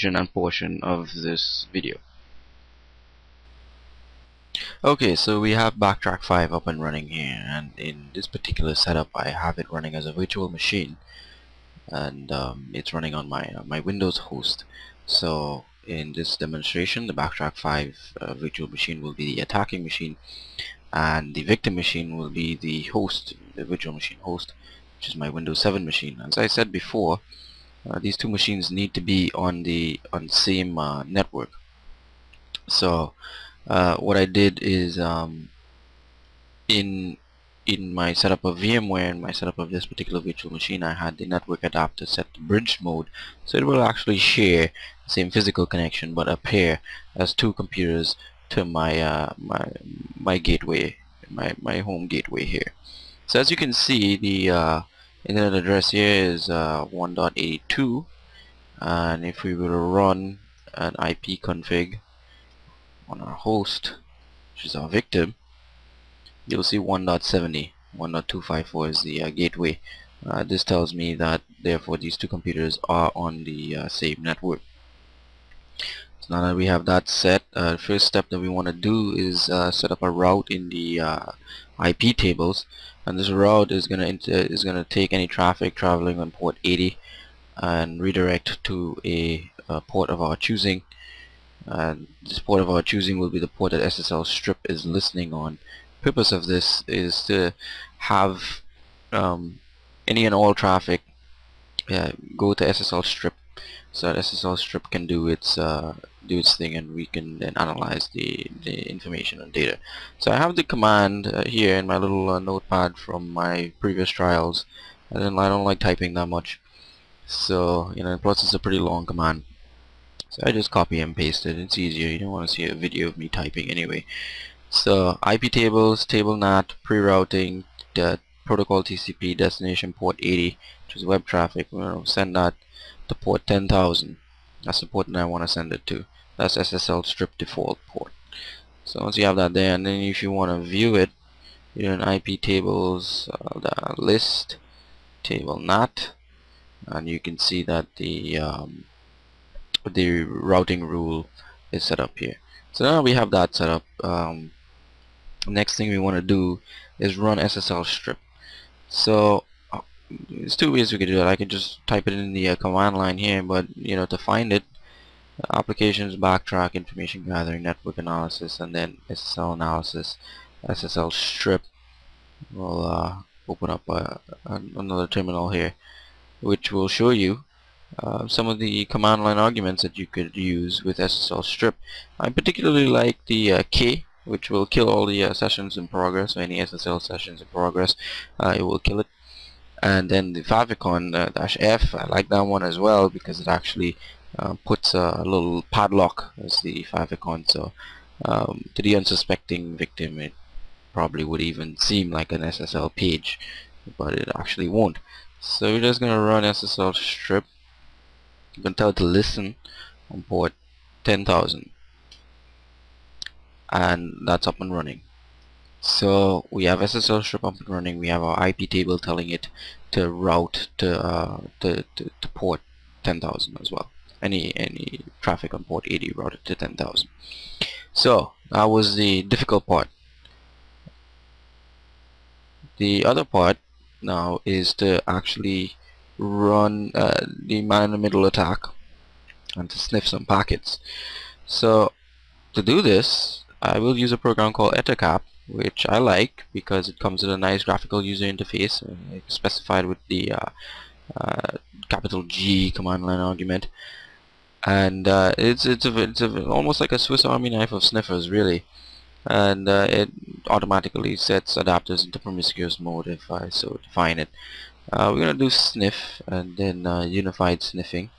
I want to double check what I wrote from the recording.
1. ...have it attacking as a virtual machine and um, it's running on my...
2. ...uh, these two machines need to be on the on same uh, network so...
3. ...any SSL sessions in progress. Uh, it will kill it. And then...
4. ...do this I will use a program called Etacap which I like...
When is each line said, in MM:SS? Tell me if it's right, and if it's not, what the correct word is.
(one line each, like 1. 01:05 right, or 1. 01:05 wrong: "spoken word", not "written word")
1. 00:09 wrong: "running", not "attacking"
2. 00:27 right
3. 03:06 right
4. 04:02 right.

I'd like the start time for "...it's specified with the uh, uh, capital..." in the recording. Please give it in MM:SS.
04:09.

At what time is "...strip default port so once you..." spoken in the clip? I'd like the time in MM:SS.
02:17.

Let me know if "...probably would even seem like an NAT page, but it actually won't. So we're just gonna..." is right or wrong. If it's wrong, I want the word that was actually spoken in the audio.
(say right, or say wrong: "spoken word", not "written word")
wrong: "SSL", not "NAT".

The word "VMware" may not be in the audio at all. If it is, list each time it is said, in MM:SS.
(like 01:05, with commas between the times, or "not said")
00:38.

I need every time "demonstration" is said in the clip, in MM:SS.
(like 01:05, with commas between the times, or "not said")
00:16.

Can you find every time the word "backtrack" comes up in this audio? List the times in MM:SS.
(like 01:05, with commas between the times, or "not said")
00:05, 00:17, 02:46.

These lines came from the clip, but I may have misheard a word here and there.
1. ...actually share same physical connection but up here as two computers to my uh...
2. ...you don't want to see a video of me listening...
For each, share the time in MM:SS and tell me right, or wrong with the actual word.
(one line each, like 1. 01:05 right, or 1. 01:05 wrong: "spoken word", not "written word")
1. 00:43 right
2. 02:02 wrong: "typing", not "listening".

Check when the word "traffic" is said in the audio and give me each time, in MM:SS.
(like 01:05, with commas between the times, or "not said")
01:25, 01:40, 02:11, 03:45.